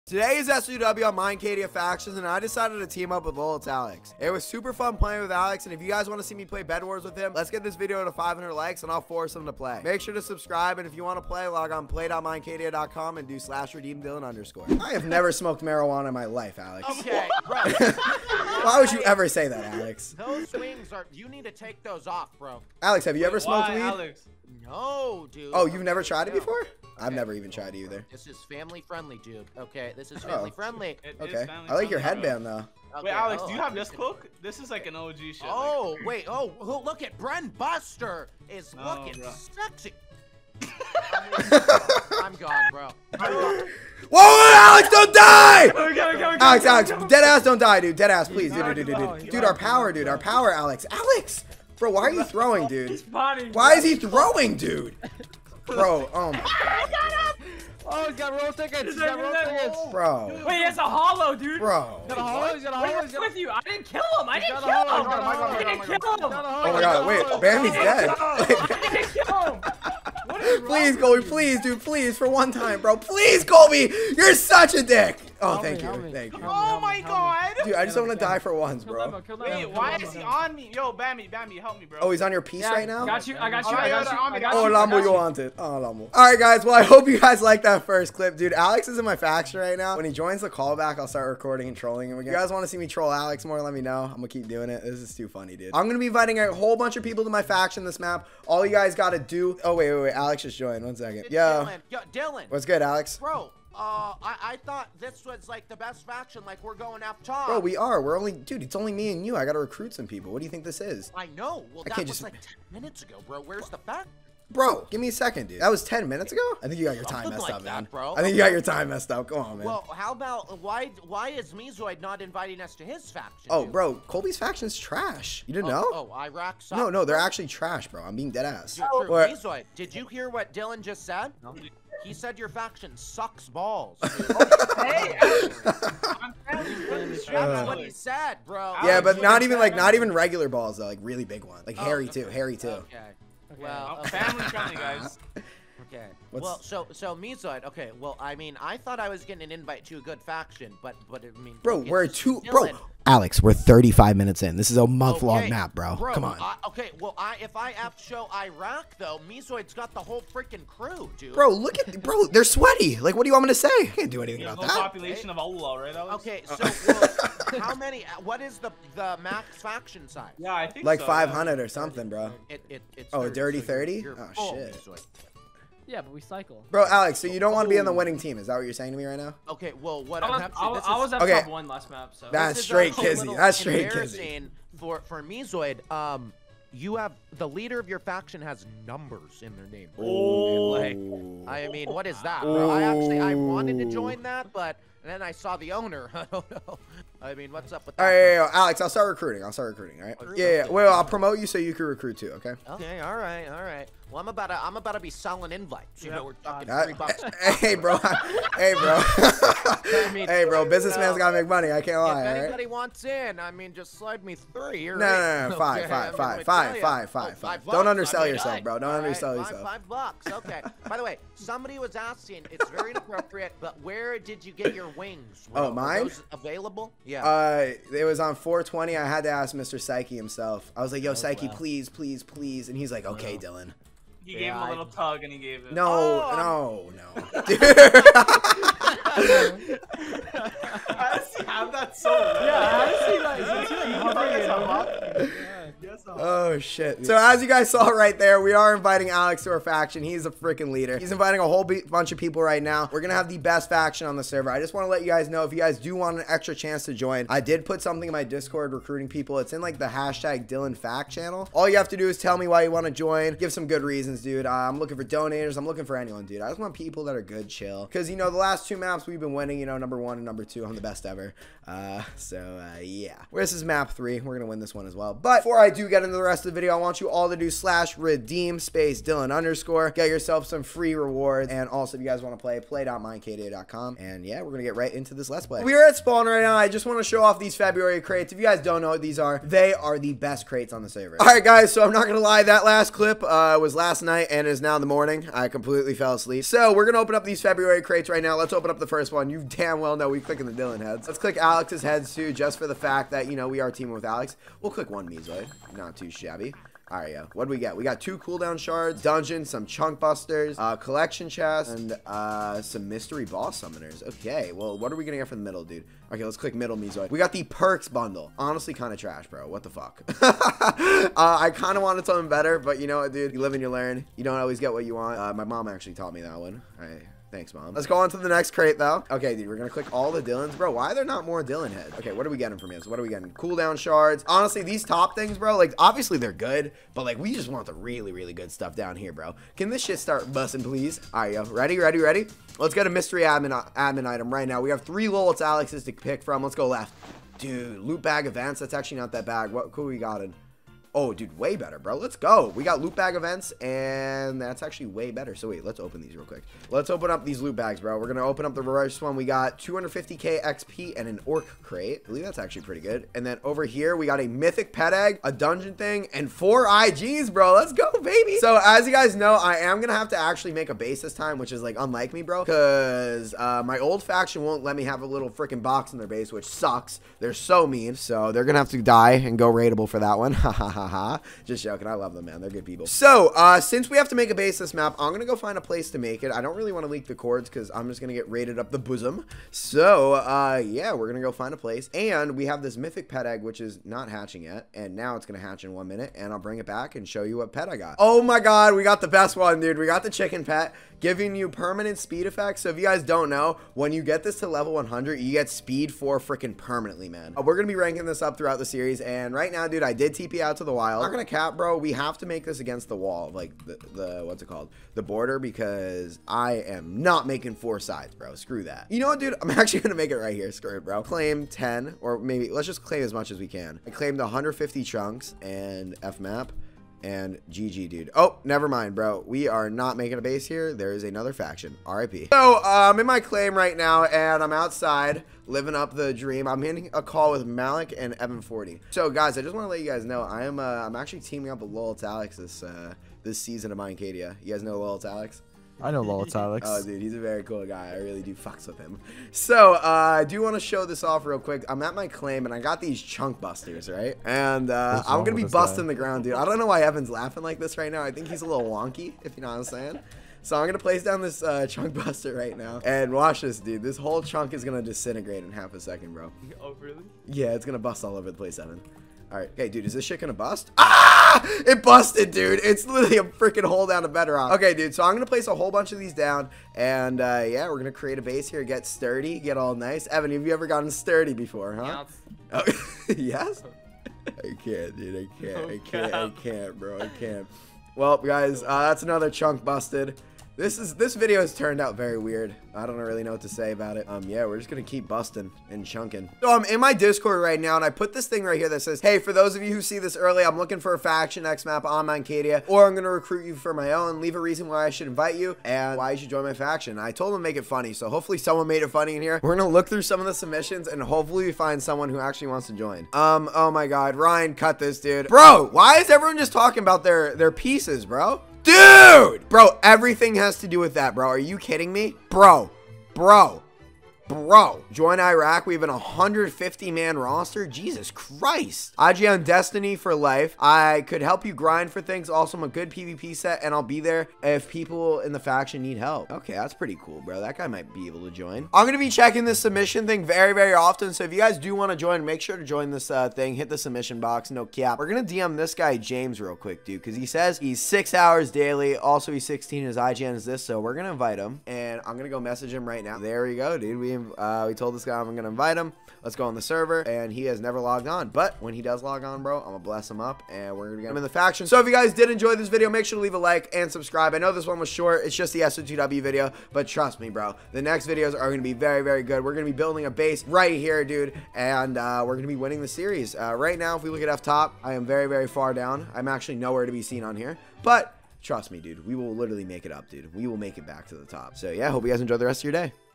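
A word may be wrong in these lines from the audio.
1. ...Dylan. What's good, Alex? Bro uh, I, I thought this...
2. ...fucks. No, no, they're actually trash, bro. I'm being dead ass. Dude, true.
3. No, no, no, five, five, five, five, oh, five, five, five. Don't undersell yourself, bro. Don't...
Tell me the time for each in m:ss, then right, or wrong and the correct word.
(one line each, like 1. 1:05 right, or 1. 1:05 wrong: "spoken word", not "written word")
1. 1:42 right
2. 2:06 wrong: "sucks", not "fucks"
3. 3:34 right.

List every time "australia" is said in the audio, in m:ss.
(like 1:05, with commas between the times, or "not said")
not said.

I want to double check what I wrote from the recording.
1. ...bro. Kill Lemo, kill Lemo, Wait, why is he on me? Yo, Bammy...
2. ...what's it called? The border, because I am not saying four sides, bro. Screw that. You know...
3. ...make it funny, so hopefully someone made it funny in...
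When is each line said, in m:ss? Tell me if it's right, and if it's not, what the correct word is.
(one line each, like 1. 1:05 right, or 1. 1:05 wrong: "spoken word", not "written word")
1. 1:18 right
2. 6:54 wrong: "making", not "saying"
3. 8:27 right.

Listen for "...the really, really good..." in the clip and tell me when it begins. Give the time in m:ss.
5:37.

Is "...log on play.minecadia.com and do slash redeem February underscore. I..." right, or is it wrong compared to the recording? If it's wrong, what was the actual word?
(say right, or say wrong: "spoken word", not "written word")
wrong: "Dylan", not "February".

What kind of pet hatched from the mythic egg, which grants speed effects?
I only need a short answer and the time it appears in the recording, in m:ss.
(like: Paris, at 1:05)
Chicken pet, at 6:40.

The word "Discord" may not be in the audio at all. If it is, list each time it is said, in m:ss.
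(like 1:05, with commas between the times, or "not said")
4:18, 8:16.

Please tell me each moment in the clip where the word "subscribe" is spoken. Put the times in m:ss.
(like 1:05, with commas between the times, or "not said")
0:10, 9:23.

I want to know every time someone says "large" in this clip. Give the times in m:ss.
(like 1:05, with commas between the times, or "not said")
not said.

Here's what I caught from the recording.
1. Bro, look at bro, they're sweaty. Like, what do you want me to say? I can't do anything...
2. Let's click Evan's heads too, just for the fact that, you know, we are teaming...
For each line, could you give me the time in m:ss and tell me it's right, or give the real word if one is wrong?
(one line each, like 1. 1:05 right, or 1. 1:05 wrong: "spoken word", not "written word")
1. 2:41 right
2. 5:01 wrong: "Alex", not "Evan".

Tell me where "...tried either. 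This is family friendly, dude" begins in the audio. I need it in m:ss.
0:27.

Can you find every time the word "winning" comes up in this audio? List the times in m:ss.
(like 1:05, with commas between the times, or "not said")
2:57, 4:29, 9:32.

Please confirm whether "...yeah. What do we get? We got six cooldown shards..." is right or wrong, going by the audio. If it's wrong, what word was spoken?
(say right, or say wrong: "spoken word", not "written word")
wrong: "two", not "six".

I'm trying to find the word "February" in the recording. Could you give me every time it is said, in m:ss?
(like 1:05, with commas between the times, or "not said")
4:47, 4:57.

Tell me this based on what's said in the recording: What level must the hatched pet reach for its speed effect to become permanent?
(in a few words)
100.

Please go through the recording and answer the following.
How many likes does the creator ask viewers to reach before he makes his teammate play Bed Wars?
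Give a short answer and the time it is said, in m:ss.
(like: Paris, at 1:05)
500, at 0:08.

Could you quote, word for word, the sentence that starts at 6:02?
I believe that's actually pretty good.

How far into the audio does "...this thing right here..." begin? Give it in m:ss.
8:18.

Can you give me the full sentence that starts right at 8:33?
Um, oh my God, Ryan, cut this, dude.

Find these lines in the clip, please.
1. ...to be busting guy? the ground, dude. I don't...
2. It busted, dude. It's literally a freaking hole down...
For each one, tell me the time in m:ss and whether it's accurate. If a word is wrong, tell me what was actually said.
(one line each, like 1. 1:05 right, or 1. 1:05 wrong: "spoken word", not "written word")
1. 7:35 right
2. 7:51 right.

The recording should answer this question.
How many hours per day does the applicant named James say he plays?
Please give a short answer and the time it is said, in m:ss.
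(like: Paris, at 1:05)
6 hours, at 9:07.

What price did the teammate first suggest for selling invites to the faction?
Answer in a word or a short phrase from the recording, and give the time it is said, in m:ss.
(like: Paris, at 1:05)
3 dollars, at 3:26.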